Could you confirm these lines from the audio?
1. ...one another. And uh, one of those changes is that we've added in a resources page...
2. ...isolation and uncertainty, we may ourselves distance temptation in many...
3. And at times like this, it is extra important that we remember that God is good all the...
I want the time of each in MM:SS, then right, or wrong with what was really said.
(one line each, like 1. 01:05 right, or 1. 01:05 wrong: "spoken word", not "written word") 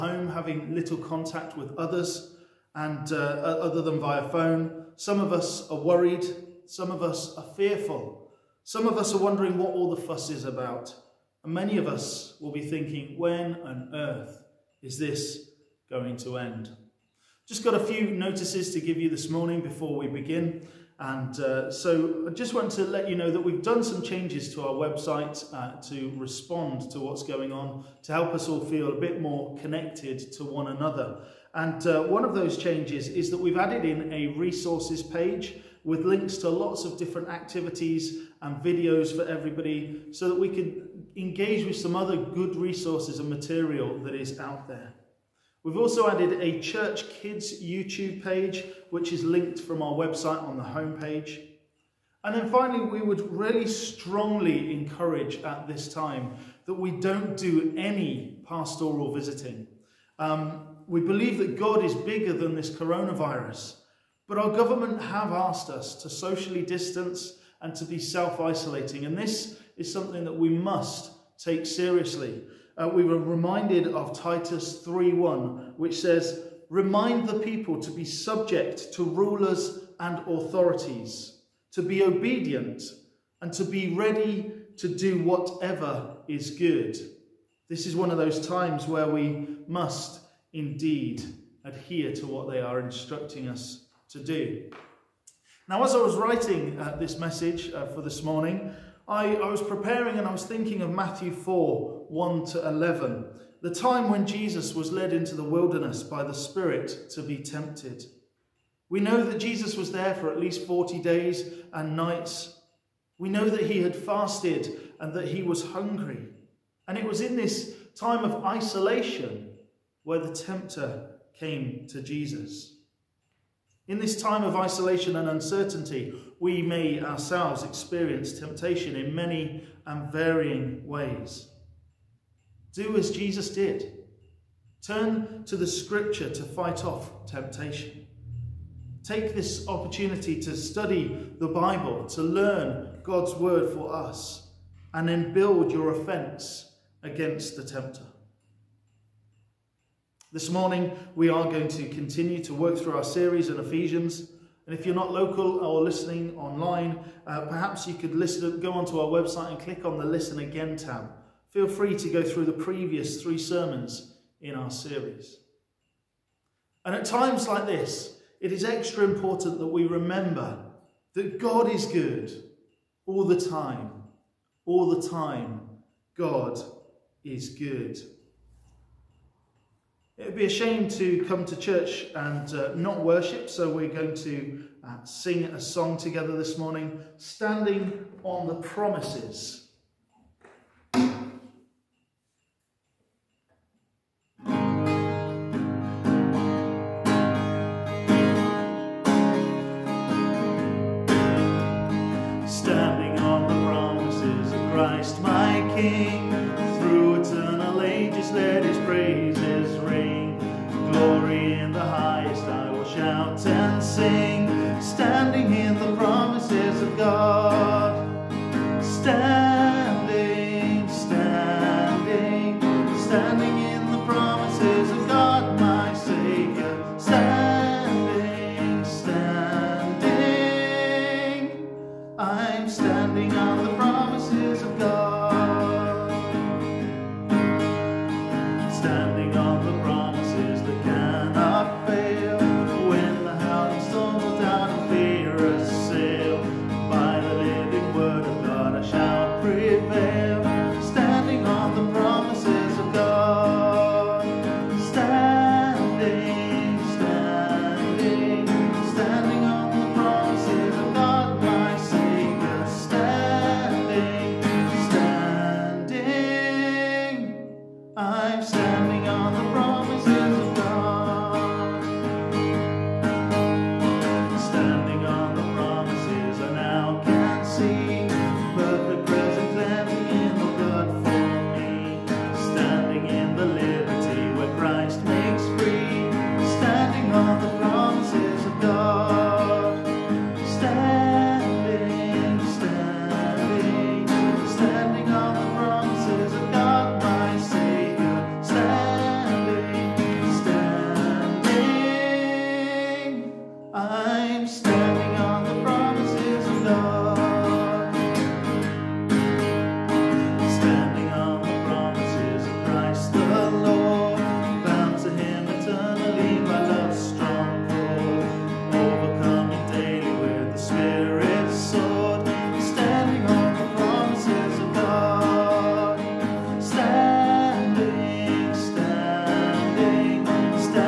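1. 00:30 right
2. 02:04 wrong: "experience", not "distance"
3. 02:46 right.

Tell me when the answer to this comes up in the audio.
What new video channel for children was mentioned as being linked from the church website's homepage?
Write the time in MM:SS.
00:46.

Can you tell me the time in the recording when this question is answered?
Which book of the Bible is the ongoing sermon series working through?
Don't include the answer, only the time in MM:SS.
02:33.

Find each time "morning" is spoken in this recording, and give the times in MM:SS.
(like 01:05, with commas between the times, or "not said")
00:19, 01:38, 02:30, 03:06.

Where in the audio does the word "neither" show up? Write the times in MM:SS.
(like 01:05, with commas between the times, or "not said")
not said.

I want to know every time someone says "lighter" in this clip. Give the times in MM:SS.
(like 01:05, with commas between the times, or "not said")
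not said.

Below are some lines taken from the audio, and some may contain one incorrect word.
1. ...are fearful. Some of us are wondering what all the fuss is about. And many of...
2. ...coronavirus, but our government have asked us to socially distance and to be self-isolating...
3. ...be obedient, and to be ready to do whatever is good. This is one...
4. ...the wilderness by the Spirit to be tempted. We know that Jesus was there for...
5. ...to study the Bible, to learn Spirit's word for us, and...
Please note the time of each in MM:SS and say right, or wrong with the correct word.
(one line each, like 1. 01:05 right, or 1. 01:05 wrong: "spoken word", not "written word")
1. 00:07 right
2. 01:02 right
3. 01:21 right
4. 01:45 right
5. 02:20 wrong: "God", not "Spirit".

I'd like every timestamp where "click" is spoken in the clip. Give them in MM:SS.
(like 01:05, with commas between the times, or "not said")
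02:39.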